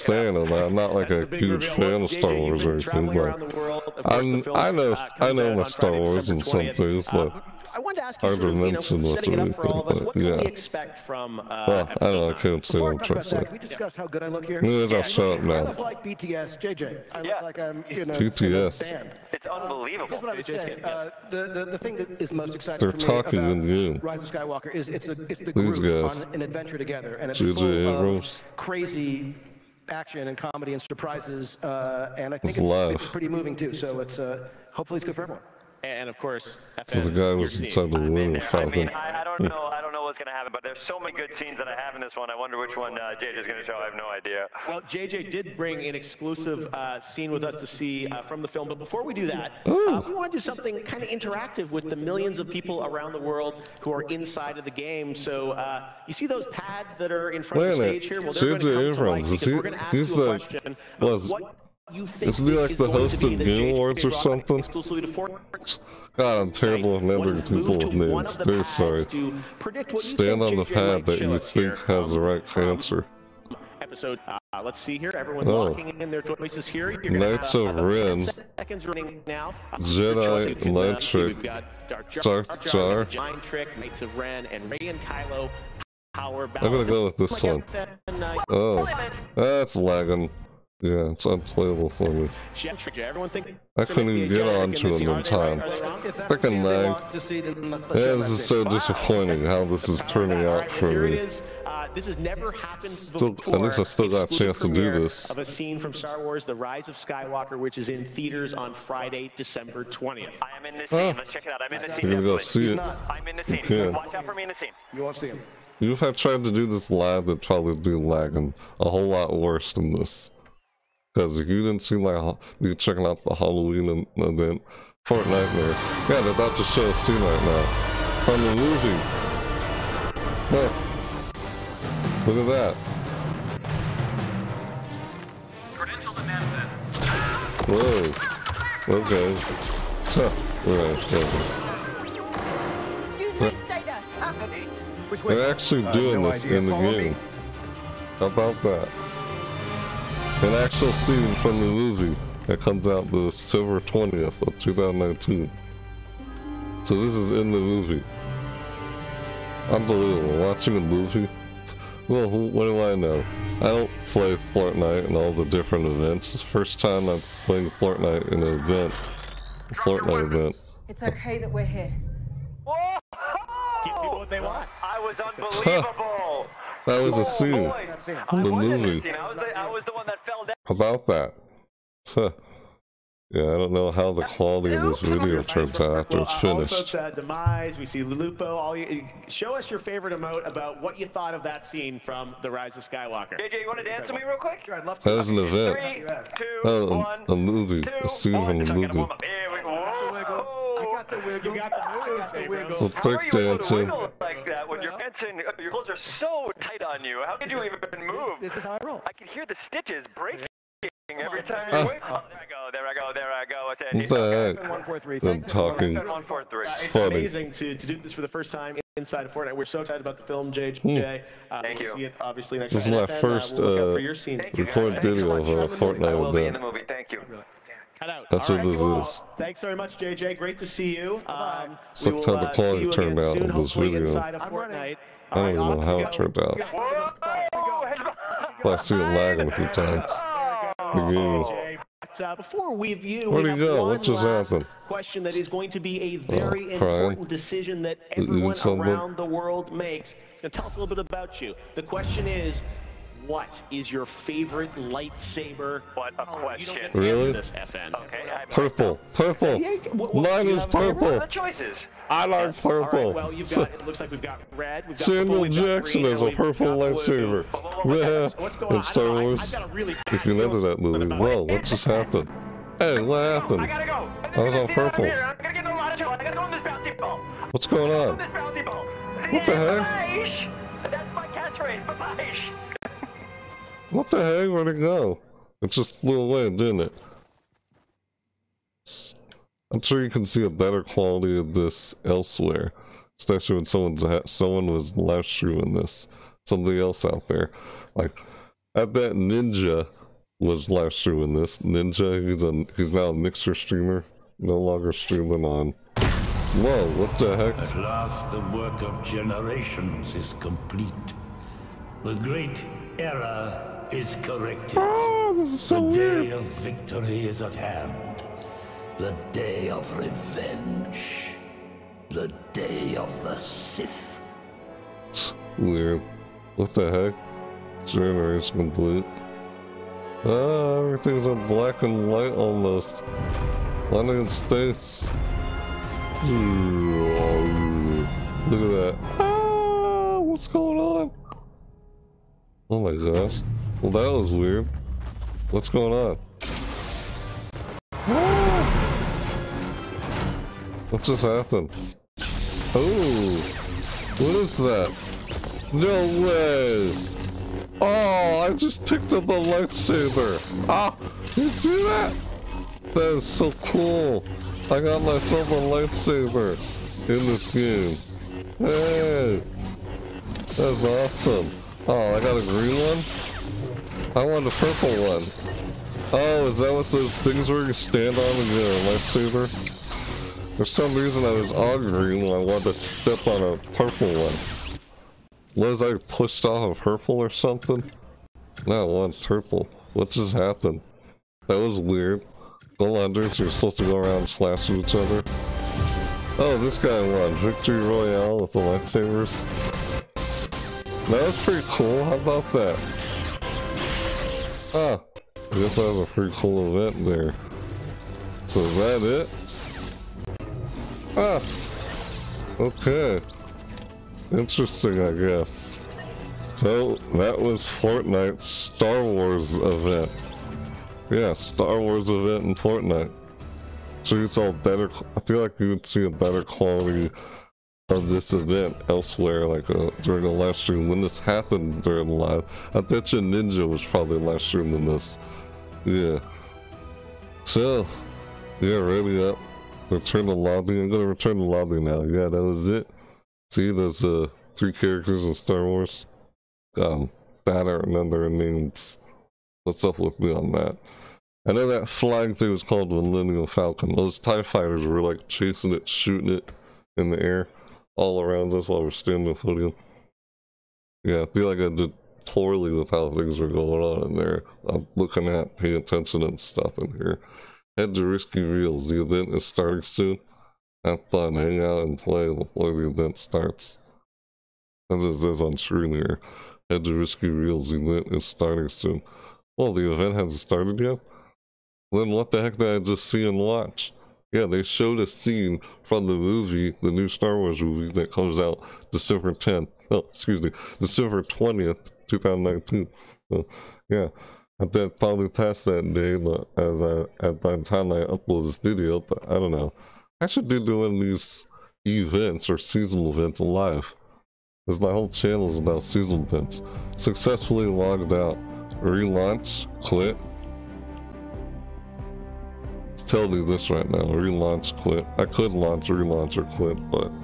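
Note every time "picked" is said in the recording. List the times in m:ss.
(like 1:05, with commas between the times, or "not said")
5:58.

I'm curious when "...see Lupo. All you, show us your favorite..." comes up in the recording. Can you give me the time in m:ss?
3:07.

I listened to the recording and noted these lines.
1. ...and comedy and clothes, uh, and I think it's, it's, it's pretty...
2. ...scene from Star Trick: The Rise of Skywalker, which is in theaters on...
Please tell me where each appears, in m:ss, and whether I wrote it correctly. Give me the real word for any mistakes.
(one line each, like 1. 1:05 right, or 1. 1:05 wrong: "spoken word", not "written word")
1. 0:30 wrong: "surprises", not "clothes"
2. 1:45 wrong: "Wars", not "Trick".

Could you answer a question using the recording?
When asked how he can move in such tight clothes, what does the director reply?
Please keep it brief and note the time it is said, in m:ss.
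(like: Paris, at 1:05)
This is how I roll, at 3:28.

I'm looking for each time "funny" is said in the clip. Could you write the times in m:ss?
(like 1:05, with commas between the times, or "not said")
3:36.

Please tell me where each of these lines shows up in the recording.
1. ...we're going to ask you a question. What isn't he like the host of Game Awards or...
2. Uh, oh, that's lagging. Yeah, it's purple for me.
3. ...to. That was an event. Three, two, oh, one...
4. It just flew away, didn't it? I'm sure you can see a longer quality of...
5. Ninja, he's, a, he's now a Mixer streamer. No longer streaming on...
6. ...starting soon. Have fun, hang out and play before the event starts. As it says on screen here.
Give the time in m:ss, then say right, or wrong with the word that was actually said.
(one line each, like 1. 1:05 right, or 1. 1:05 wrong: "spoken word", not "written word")
1. 0:59 right
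2. 1:27 wrong: "unplayable", not "purple"
3. 3:15 right
4. 4:45 wrong: "better", not "longer"
5. 5:01 right
6. 7:49 right.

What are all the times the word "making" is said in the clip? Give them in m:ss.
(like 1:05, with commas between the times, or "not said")
not said.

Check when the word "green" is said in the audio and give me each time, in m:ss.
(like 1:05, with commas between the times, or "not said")
4:26, 6:12, 6:21.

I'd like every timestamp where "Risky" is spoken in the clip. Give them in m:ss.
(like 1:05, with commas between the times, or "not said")
7:48, 7:56.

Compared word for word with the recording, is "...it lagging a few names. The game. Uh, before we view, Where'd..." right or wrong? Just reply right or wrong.
wrong.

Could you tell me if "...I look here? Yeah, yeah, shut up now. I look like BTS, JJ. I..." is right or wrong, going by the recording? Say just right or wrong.
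right.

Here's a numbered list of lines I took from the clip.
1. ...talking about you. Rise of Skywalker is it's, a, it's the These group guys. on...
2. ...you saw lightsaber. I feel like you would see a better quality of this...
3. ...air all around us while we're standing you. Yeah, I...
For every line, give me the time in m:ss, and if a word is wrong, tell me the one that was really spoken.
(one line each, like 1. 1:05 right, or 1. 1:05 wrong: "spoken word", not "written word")
1. 0:23 right
2. 7:04 wrong: "better", not "lightsaber"
3. 7:37 right.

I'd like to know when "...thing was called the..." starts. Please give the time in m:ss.
7:32.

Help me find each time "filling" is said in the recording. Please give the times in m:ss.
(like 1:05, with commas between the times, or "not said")
not said.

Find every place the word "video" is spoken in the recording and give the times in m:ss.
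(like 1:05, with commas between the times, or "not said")
3:05, 3:45, 3:53, 8:18.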